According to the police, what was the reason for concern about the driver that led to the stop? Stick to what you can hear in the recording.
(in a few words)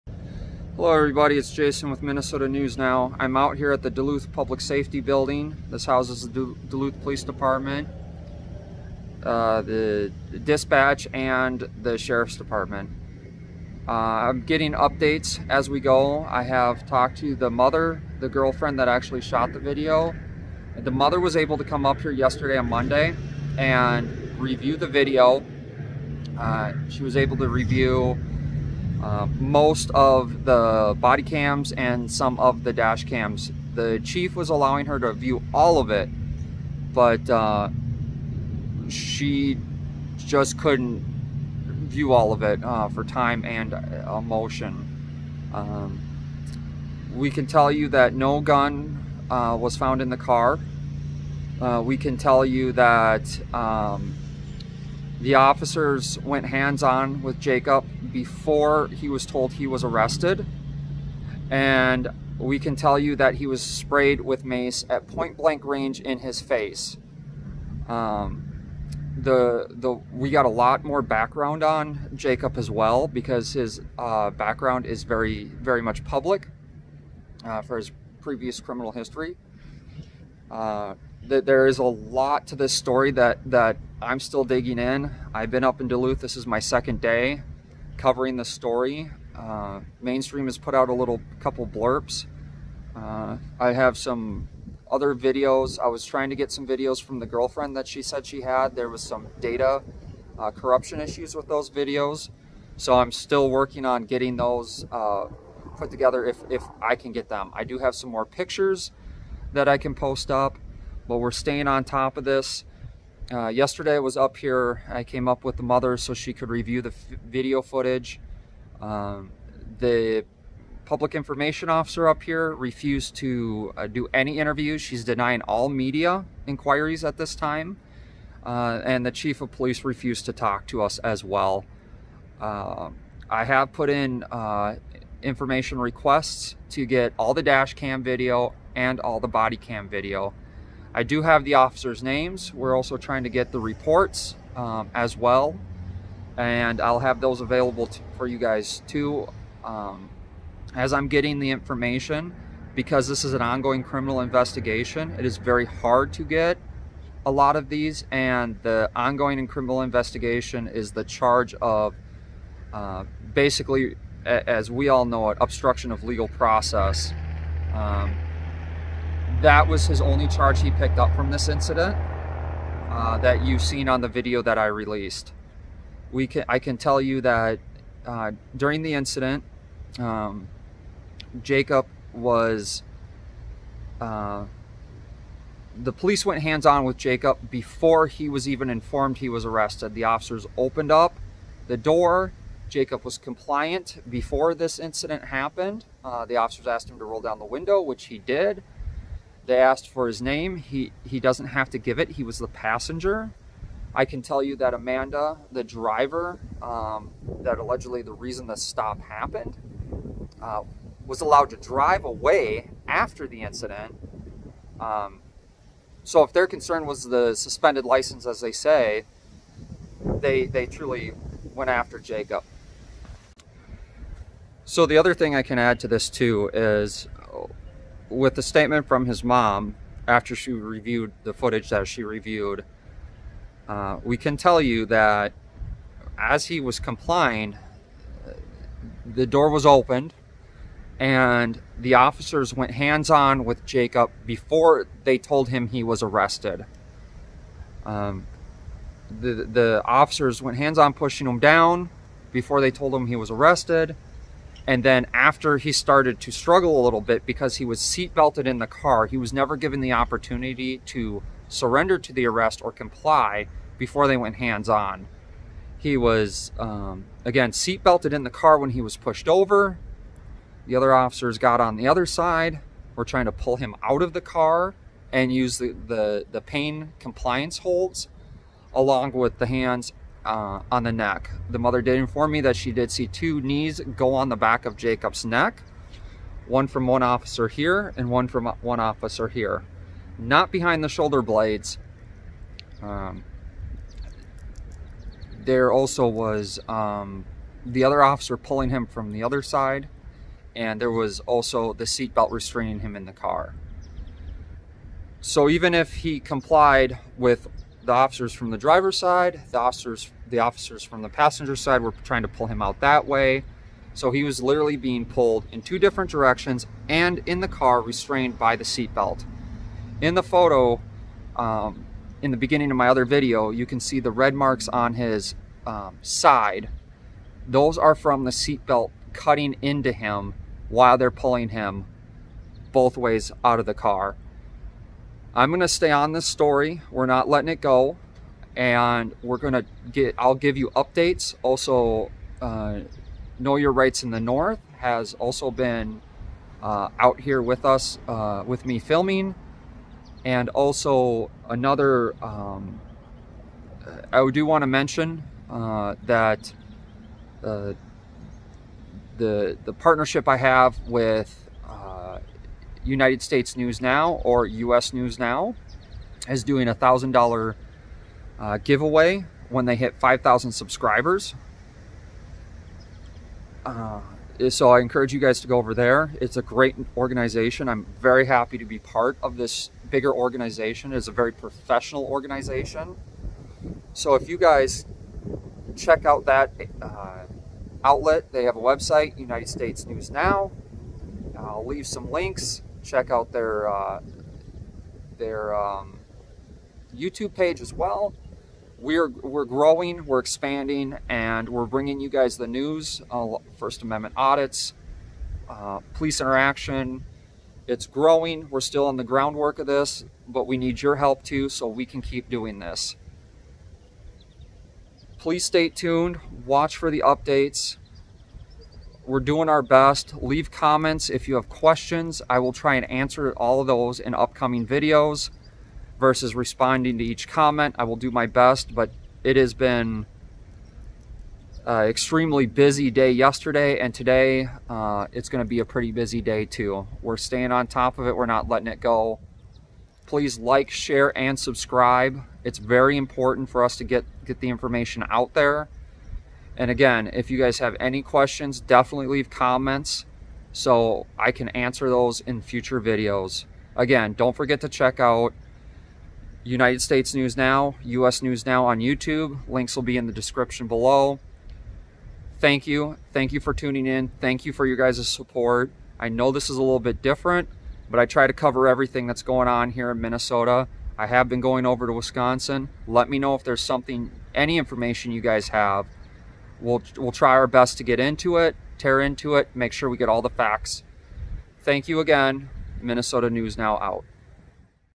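Suspended license.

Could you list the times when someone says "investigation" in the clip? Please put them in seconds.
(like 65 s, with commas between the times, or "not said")
154 s, 159 s.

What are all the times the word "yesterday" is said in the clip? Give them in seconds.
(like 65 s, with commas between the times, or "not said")
22 s, 113 s, 433 s.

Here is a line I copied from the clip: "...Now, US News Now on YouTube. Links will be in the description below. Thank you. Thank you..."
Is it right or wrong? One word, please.
right.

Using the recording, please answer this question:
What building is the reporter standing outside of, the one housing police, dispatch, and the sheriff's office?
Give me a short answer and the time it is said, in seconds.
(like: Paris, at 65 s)
Duluth Public Safety Building, at 3 s.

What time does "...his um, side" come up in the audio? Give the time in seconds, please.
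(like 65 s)
324 s.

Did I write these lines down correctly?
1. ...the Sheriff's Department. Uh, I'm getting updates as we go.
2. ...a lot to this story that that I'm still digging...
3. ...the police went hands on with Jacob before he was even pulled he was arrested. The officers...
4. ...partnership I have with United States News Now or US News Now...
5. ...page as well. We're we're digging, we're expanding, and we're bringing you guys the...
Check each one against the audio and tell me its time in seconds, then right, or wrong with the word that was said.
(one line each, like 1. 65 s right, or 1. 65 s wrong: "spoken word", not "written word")
1. 11 s right
2. 81 s right
3. 185 s wrong: "informed", not "pulled"
4. 359 s right
5. 397 s wrong: "growing", not "digging".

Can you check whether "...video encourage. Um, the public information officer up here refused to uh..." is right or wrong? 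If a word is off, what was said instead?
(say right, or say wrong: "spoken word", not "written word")
wrong: "footage", not "encourage".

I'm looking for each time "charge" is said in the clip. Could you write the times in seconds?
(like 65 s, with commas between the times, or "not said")
161 s, 170 s.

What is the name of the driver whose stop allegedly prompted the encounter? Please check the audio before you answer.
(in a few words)
Amanda.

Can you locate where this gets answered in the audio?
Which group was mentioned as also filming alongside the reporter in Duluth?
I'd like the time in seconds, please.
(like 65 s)
343 s.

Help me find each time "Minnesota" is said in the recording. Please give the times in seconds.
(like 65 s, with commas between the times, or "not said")
2 s, 469 s, 482 s.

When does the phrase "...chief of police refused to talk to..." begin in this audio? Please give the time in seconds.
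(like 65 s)
129 s.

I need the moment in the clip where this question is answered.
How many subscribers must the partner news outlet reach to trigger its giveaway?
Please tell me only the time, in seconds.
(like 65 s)
369 s.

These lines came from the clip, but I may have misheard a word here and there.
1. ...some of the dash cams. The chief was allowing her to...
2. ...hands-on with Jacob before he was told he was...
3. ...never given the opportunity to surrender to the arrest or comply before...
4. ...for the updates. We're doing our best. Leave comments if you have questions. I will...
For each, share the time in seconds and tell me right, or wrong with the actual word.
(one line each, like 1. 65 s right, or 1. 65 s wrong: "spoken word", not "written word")
1. 32 s right
2. 56 s right
3. 259 s right
4. 416 s right.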